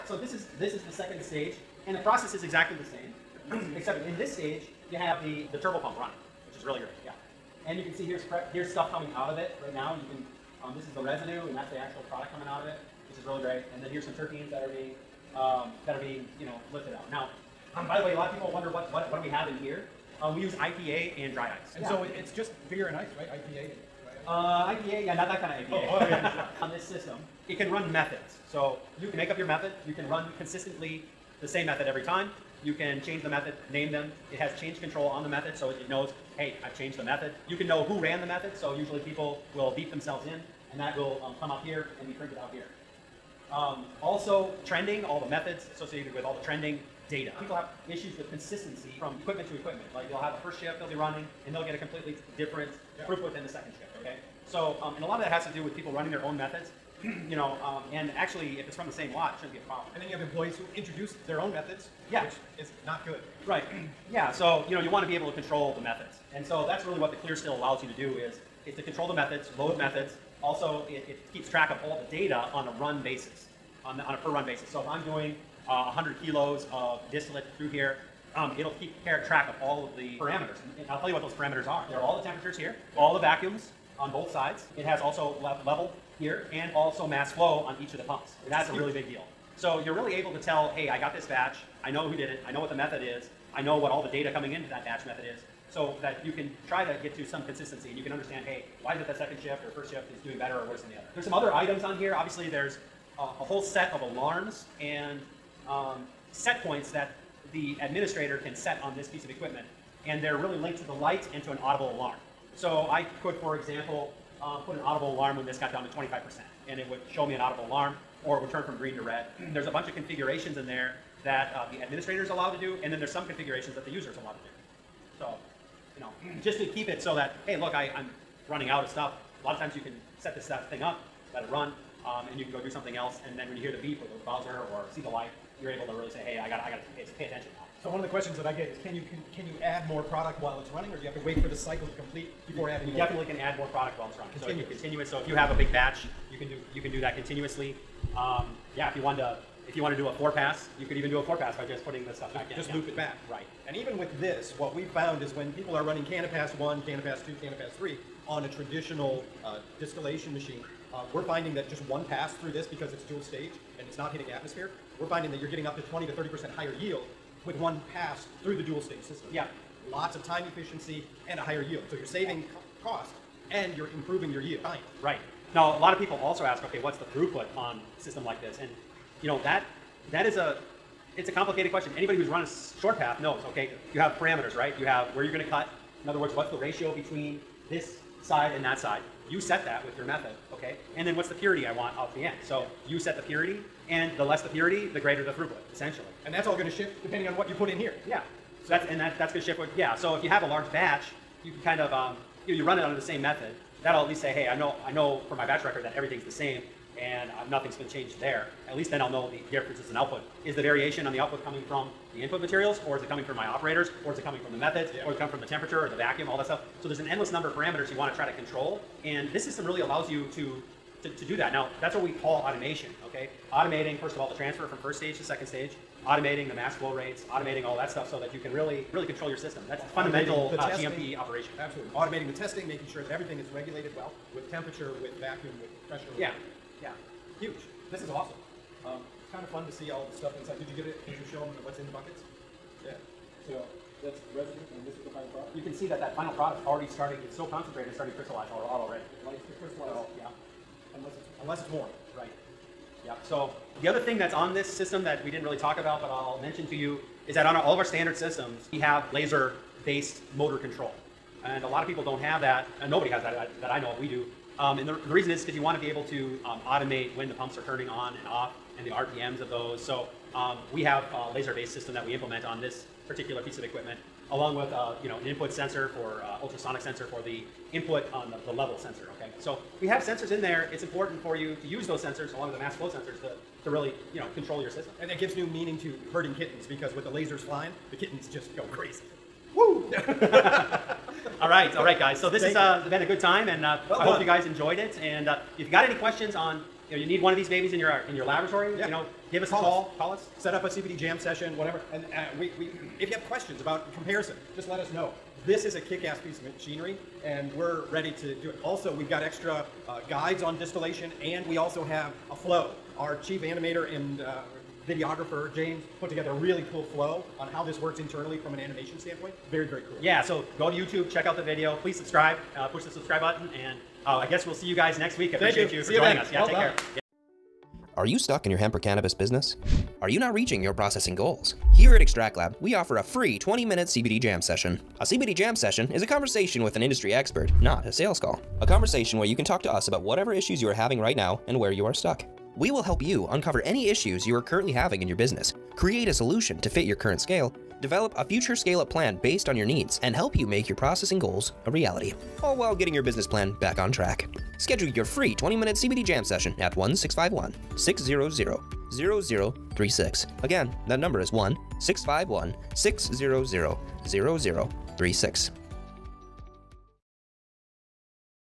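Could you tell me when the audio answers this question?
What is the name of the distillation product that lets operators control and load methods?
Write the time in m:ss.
1:07.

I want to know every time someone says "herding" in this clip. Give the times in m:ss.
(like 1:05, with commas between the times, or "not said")
4:46.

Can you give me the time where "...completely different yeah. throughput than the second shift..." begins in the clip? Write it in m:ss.
0:51.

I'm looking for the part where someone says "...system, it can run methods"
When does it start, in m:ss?
0:26.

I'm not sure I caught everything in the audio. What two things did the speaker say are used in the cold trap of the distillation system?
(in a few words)
IPA and dry ice.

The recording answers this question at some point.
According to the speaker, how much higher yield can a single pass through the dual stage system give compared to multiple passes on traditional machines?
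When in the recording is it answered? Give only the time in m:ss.
2:45.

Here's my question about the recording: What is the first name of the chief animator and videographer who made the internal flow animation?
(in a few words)
James.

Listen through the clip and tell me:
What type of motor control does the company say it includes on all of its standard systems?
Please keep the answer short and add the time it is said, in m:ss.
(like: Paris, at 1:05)
laser-based motor control, at 4:19.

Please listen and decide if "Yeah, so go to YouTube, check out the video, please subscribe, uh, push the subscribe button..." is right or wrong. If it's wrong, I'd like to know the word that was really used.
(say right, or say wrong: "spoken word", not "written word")
right.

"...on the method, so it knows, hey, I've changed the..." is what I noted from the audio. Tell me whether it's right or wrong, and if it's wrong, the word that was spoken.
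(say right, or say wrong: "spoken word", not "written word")
right.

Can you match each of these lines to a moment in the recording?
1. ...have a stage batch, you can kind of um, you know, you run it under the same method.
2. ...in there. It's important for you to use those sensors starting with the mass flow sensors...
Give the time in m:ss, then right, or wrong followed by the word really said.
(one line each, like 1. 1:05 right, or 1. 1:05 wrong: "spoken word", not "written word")
1. 3:20 wrong: "large", not "stage"
2. 4:40 wrong: "along", not "starting".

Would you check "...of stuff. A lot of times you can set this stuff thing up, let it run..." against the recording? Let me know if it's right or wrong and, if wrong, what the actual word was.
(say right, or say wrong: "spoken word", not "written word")
right.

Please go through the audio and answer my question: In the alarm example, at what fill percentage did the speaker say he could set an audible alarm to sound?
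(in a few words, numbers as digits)
25%.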